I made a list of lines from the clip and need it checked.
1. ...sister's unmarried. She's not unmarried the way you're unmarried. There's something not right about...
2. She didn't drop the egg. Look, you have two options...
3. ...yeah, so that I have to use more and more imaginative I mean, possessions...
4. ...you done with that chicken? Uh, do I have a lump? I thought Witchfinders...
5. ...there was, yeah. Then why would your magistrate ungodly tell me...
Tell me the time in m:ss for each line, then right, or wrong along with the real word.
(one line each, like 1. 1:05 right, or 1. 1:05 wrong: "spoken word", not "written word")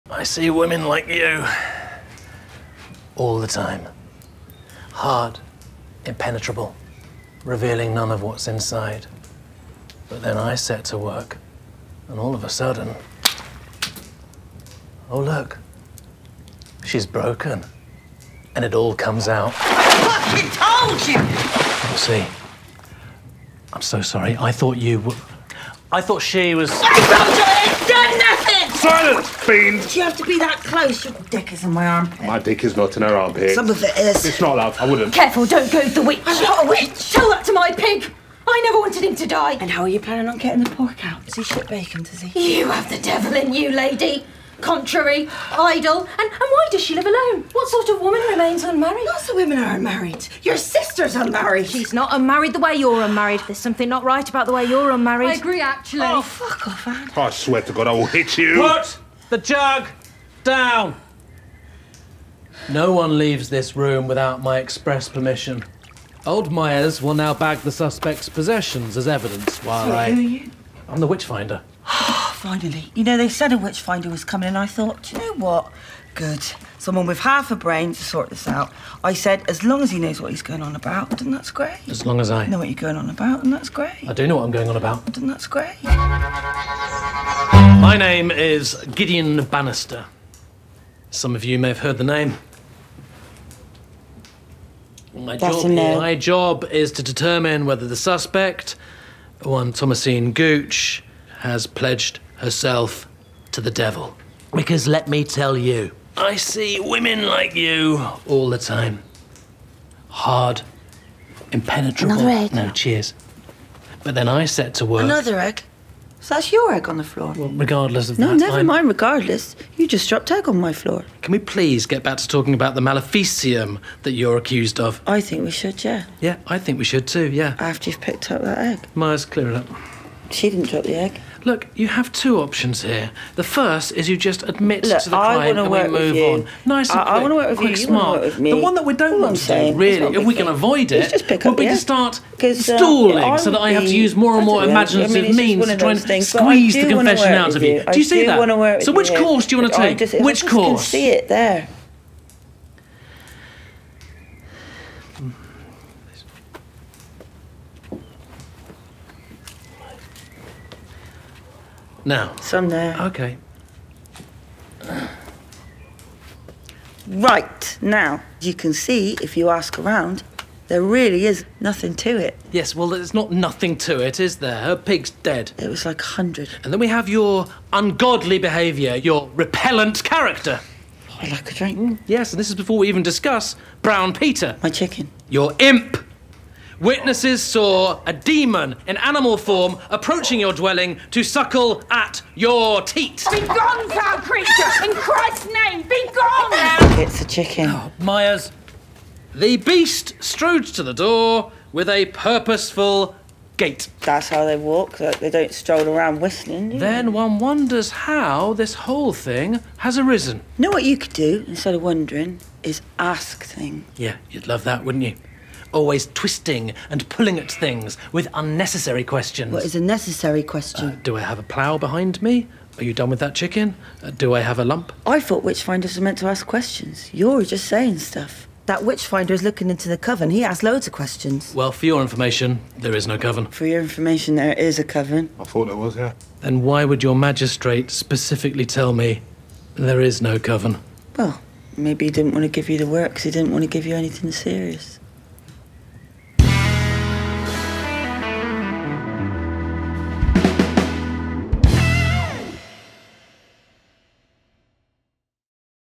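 1. 0:50 right
2. 2:10 right
3. 2:23 wrong: "means", not "possessions"
4. 3:42 right
5. 3:55 wrong: "specifically", not "ungodly".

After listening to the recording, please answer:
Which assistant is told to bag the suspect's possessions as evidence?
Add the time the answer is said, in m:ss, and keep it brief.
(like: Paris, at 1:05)
Old Myers, at 1:06.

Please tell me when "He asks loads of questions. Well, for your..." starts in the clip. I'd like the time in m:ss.
3:50.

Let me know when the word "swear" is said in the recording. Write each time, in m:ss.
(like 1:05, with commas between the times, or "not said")
0:57.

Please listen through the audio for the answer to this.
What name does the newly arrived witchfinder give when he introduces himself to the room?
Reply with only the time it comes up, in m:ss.
1:28.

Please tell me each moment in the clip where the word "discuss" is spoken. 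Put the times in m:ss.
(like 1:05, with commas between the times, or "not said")
3:03.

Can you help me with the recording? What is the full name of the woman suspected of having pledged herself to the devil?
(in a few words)
Thomasine Gooch.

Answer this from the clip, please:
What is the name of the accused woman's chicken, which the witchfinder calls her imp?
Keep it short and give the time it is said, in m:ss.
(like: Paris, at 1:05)
Brown Peter, at 3:03.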